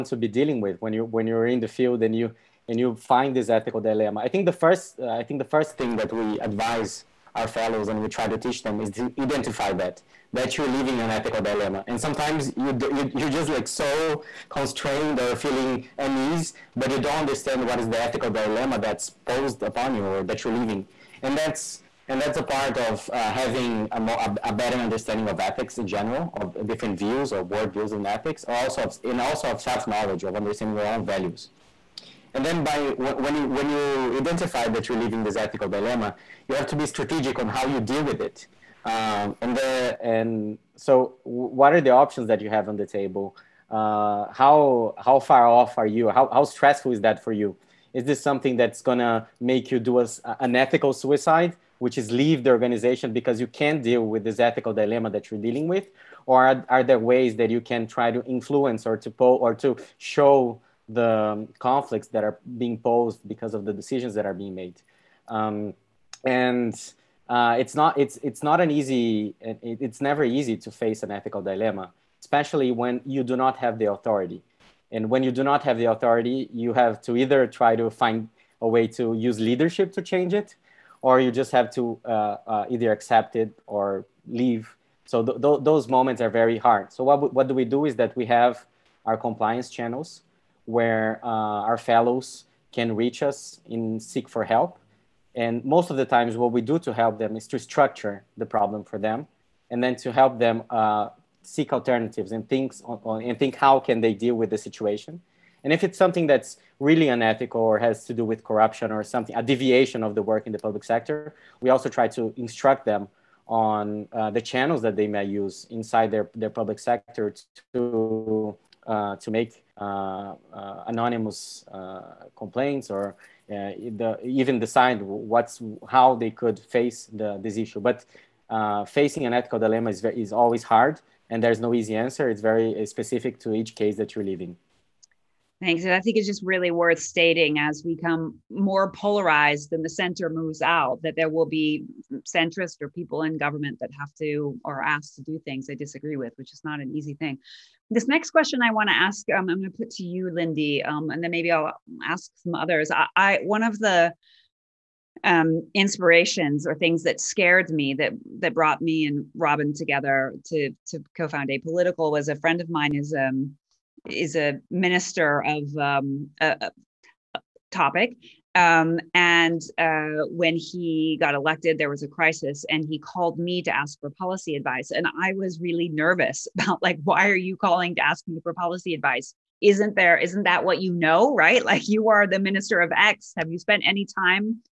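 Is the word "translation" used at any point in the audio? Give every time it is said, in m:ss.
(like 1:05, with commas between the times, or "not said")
not said.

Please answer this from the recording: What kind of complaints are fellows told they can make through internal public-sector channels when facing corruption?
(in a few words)
anonymous.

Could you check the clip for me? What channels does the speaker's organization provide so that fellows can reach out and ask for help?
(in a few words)
compliance channels.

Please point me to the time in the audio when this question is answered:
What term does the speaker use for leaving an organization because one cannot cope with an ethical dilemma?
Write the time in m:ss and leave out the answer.
0:50.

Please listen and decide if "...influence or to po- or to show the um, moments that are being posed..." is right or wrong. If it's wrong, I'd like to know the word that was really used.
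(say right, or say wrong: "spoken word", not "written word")
wrong: "conflicts", not "moments".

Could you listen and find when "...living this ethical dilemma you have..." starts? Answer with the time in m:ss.
0:34.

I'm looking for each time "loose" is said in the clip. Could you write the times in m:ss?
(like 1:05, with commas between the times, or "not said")
not said.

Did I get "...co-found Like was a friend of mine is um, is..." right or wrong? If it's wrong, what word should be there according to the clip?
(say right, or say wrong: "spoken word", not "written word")
wrong: "Apolitical", not "Like".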